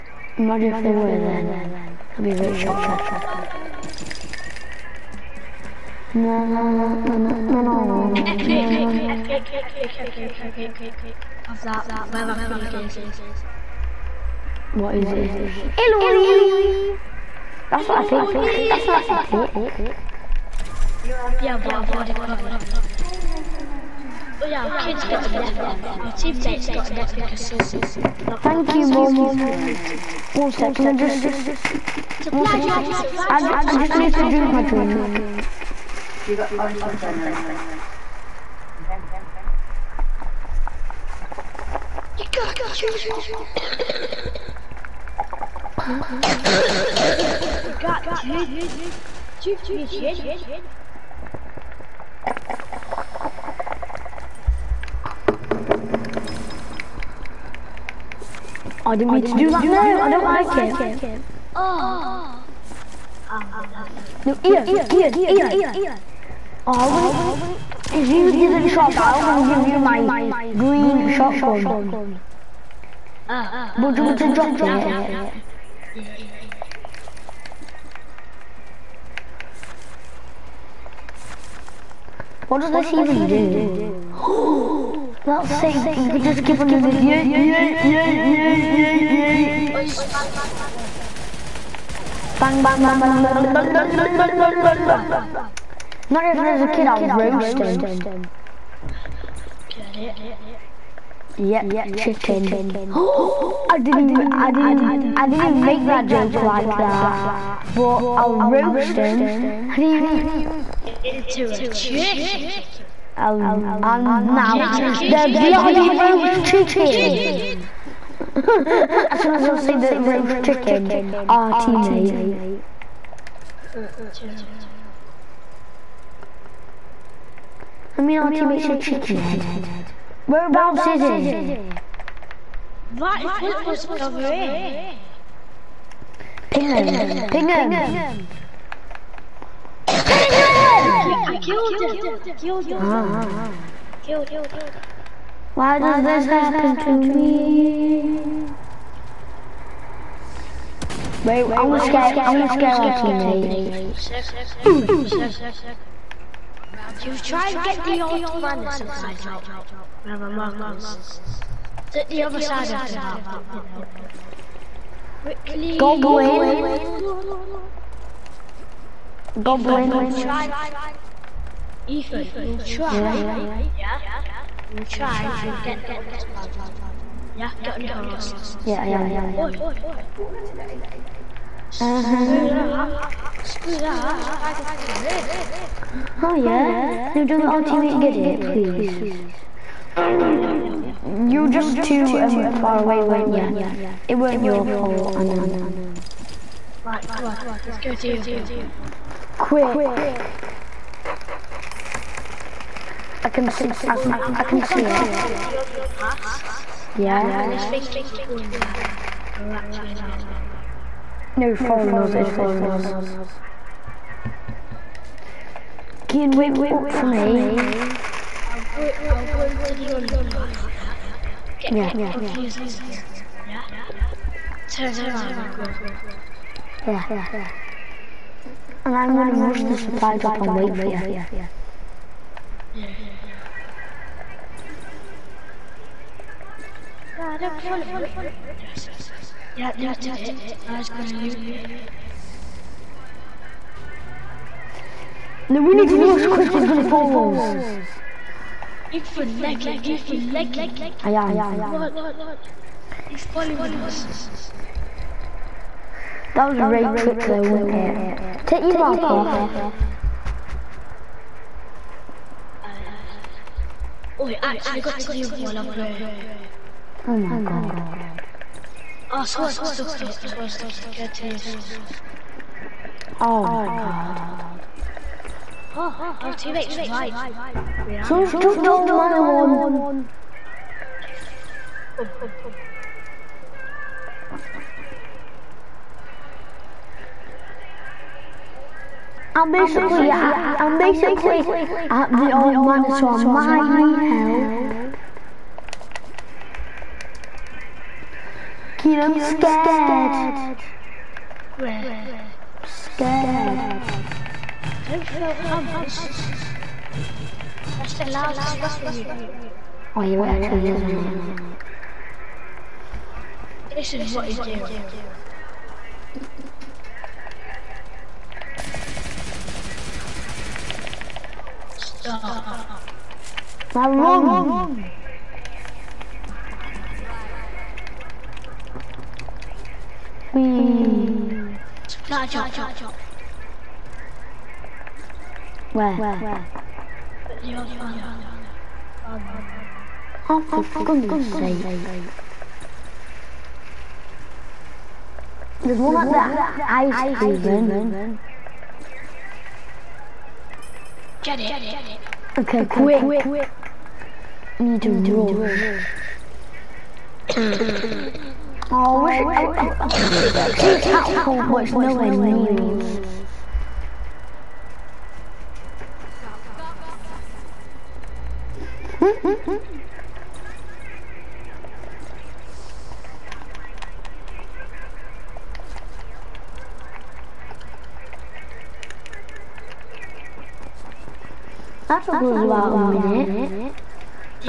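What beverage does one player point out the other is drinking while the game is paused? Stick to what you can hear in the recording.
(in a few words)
orange juice.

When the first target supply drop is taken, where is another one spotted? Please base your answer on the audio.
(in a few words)
Ice Haven.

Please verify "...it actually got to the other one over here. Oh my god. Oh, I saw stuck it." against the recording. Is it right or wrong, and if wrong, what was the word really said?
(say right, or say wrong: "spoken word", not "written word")
right.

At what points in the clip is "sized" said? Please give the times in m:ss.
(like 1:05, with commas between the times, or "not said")
not said.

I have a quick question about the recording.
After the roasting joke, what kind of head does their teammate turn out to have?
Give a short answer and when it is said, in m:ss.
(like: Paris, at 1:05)
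chicken head, at 2:08.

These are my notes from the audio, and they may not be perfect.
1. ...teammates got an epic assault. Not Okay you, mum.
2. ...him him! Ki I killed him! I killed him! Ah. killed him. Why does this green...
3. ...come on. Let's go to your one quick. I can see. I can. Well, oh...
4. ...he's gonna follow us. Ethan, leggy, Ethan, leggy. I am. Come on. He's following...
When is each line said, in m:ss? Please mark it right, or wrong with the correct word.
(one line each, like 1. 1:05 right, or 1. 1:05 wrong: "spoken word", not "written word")
1. 0:26 wrong: "Thank", not "Okay"
2. 2:17 wrong: "happen", not "green"
3. 3:17 right
4. 4:06 right.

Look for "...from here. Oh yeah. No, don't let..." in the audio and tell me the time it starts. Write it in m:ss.
3:04.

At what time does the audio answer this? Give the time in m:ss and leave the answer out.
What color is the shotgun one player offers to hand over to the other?
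1:10.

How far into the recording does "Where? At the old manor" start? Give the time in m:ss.
5:35.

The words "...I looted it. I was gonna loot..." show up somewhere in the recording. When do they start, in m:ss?
3:59.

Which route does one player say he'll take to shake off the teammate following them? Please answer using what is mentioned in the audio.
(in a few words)
the underpass.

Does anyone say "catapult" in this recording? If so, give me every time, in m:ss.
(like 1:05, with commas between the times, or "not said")
6:00.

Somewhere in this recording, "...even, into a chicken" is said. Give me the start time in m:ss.
1:49.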